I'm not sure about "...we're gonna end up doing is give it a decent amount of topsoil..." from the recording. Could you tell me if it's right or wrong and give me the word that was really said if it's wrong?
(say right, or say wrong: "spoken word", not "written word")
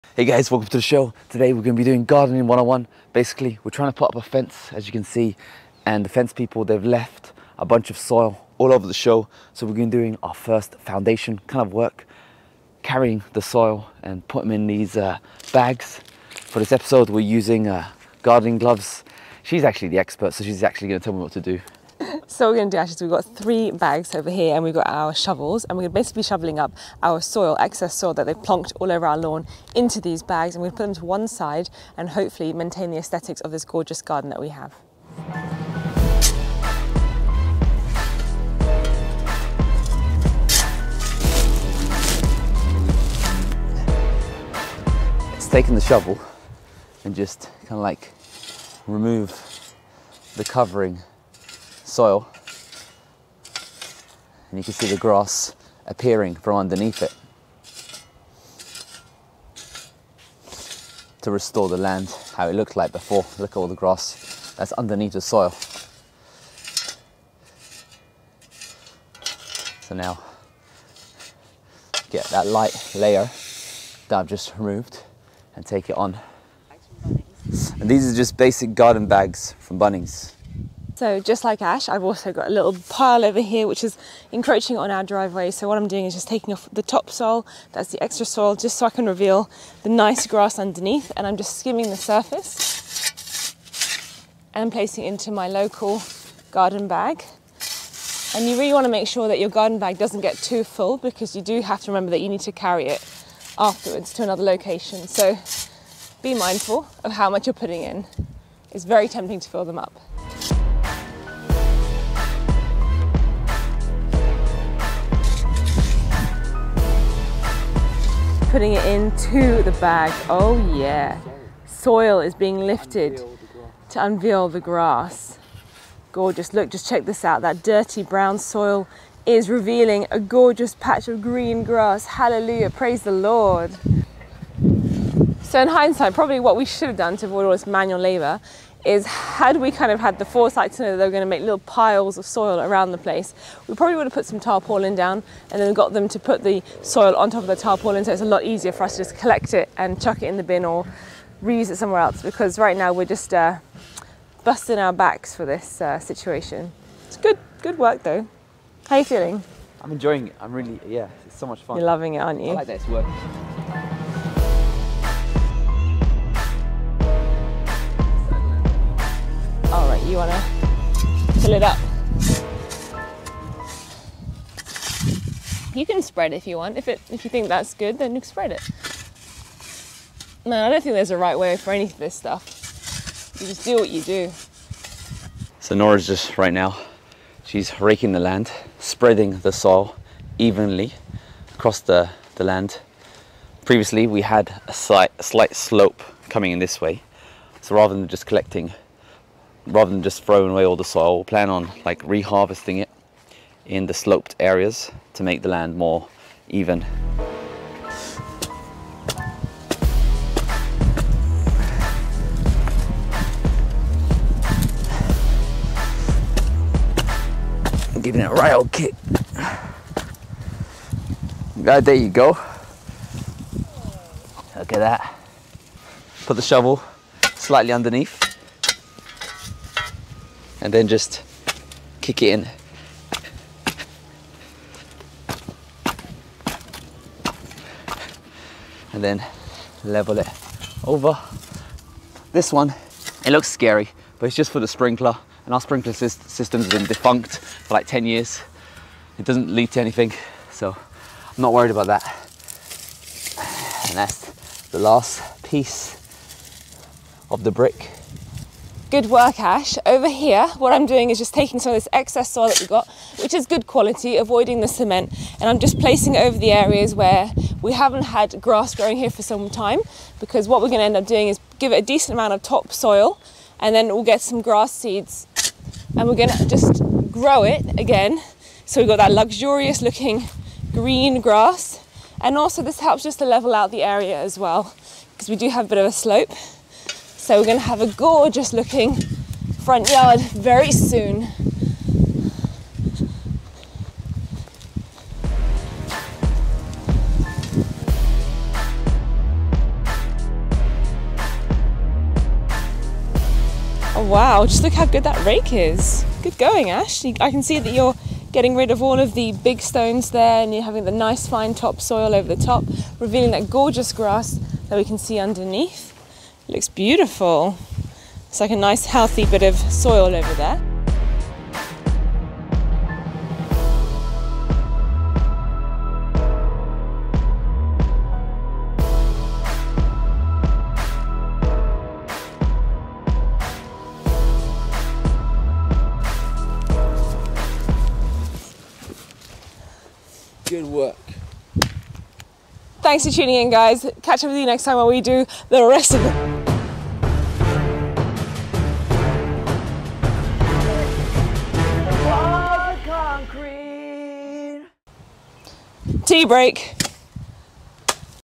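right.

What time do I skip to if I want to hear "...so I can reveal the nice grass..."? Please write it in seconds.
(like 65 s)
88 s.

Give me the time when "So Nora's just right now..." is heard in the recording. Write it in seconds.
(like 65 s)
185 s.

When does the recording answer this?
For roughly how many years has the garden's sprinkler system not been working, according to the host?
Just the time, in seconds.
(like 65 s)
247 s.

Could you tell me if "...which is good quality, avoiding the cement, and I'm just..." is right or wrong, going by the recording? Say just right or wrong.
right.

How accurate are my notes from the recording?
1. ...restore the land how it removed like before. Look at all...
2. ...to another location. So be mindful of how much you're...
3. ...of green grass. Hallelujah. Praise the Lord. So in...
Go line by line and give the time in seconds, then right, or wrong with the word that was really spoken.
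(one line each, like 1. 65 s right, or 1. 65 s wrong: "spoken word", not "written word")
1. 61 s wrong: "looked", not "removed"
2. 104 s right
3. 131 s right.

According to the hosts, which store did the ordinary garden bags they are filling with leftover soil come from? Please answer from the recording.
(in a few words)
Bunnings.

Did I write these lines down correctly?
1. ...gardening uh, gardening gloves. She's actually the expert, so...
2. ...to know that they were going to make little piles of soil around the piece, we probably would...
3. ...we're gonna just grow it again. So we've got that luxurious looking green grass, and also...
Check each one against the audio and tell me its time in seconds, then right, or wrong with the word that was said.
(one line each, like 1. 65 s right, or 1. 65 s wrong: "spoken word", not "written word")
1. 17 s wrong: "using", not "gardening"
2. 140 s wrong: "place", not "piece"
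3. 276 s right.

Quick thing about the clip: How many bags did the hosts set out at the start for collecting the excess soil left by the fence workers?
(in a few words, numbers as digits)
3.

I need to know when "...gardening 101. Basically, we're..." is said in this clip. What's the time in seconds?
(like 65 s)
2 s.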